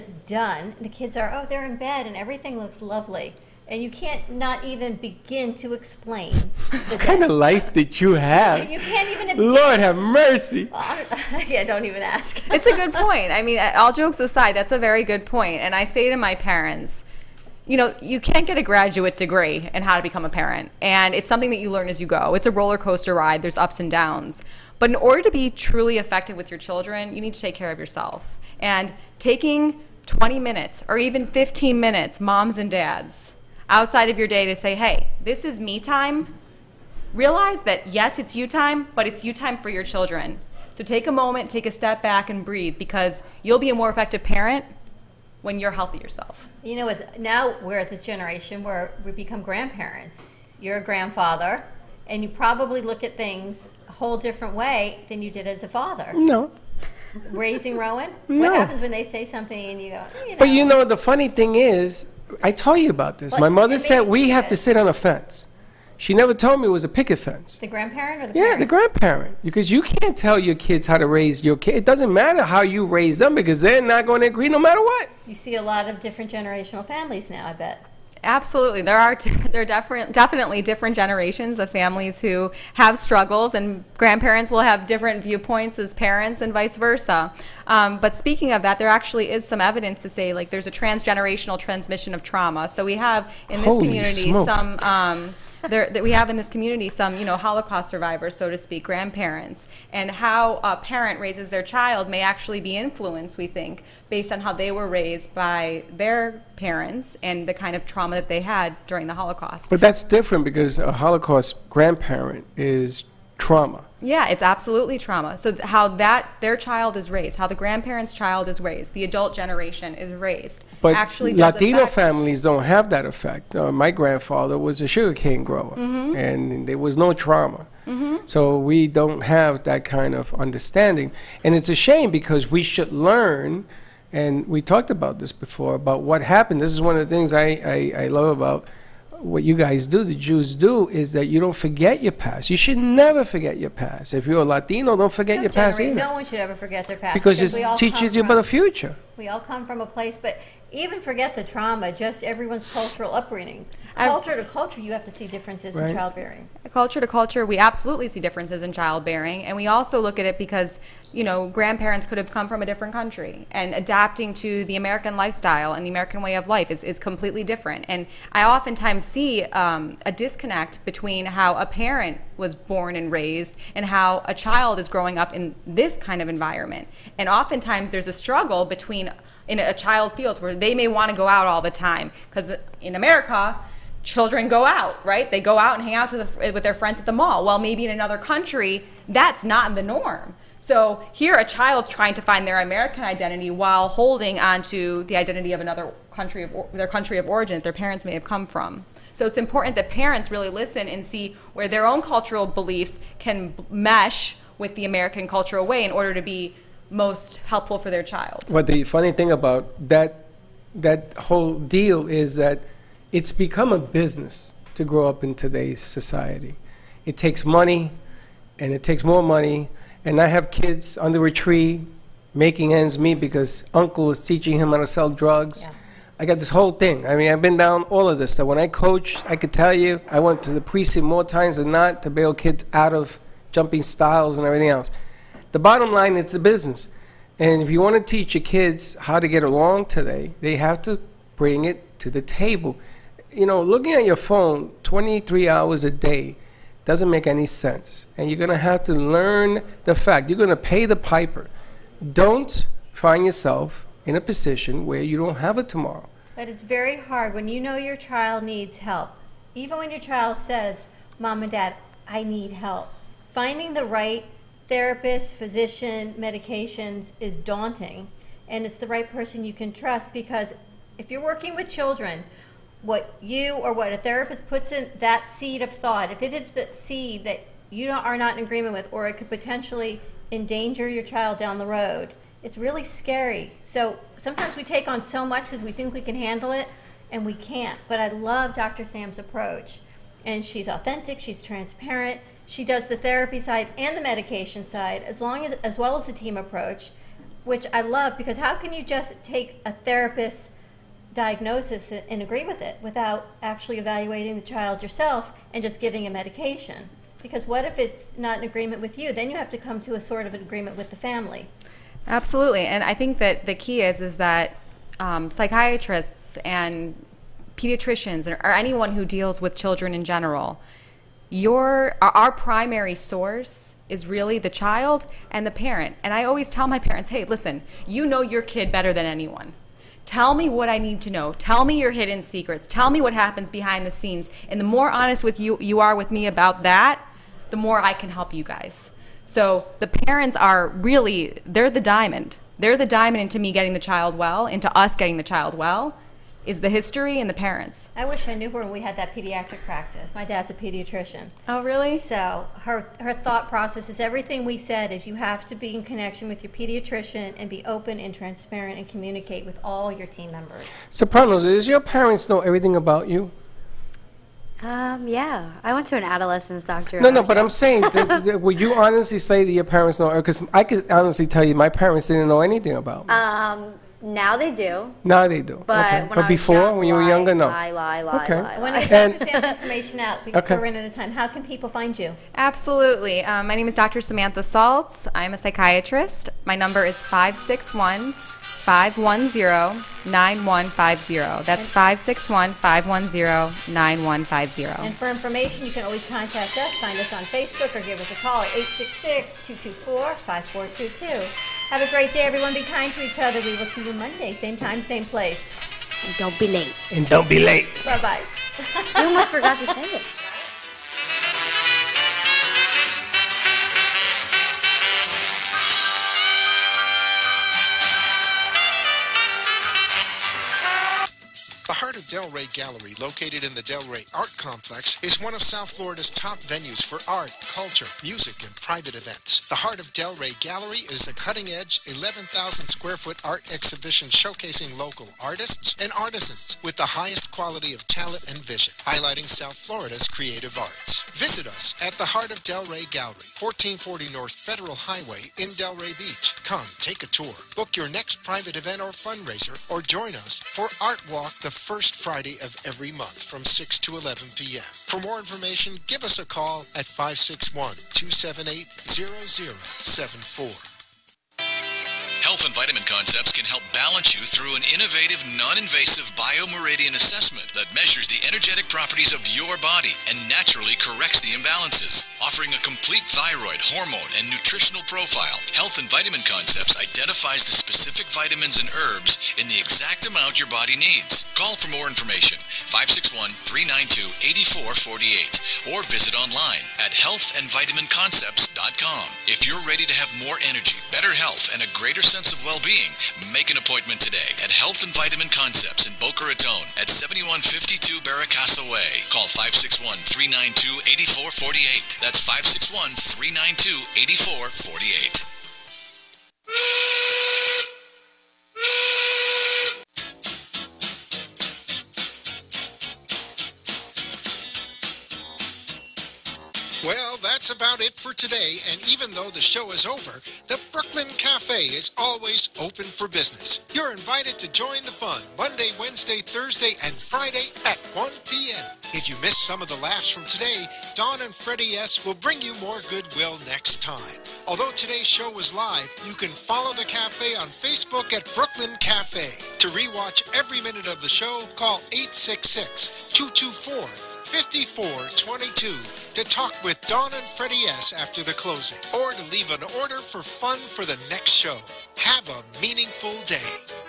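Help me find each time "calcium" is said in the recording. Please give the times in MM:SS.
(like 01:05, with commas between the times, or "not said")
not said.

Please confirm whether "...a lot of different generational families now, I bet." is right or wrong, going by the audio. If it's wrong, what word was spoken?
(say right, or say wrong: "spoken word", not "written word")
right.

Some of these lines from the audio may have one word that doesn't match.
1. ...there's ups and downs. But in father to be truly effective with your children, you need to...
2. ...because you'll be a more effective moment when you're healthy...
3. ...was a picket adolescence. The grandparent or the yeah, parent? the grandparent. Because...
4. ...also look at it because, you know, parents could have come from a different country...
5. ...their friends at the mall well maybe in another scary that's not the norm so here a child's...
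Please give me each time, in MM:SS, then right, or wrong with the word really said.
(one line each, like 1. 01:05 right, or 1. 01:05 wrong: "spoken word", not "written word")
1. 00:23 wrong: "order", not "father"
2. 00:42 wrong: "parent", not "moment"
3. 01:06 wrong: "fence", not "adolescence"
4. 02:39 wrong: "grandparents", not "parents"
5. 03:06 wrong: "country", not "scary".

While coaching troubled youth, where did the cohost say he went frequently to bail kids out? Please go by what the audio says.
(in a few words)
The precinct.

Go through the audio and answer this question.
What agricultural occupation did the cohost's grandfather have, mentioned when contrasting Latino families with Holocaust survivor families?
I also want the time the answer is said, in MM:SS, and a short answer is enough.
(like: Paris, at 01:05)
Sugar cane grower, at 02:04.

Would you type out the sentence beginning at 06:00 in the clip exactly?
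So, Carlos, does your parents know everything about you?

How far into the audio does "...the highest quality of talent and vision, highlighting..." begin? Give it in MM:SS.
07:16.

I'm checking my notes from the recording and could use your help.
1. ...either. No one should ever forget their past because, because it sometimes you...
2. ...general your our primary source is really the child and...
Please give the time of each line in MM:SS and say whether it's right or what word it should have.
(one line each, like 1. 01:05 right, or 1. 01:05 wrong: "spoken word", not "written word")
1. 02:25 wrong: "teaches", not "sometimes"
2. 05:20 right.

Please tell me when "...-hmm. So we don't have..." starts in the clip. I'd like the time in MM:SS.
02:08.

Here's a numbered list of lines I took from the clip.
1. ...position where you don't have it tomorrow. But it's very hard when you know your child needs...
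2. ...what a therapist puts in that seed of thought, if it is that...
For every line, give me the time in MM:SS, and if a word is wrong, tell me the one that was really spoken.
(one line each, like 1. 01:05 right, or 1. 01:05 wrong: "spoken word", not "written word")
1. 04:14 right
2. 04:33 right.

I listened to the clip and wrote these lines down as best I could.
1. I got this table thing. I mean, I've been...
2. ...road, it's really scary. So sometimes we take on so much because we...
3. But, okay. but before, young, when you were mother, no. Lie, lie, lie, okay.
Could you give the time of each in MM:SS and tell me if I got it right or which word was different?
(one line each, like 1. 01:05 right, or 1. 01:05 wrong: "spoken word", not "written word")
1. 03:46 wrong: "whole", not "table"
2. 04:41 right
3. 06:15 wrong: "younger", not "mother".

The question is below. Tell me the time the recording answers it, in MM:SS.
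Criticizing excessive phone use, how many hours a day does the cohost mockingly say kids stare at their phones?
04:04.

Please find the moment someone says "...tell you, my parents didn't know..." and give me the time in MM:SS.
06:11.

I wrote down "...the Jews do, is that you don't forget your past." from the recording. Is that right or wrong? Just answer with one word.
right.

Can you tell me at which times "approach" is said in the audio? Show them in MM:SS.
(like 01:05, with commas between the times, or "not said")
04:49, 04:56.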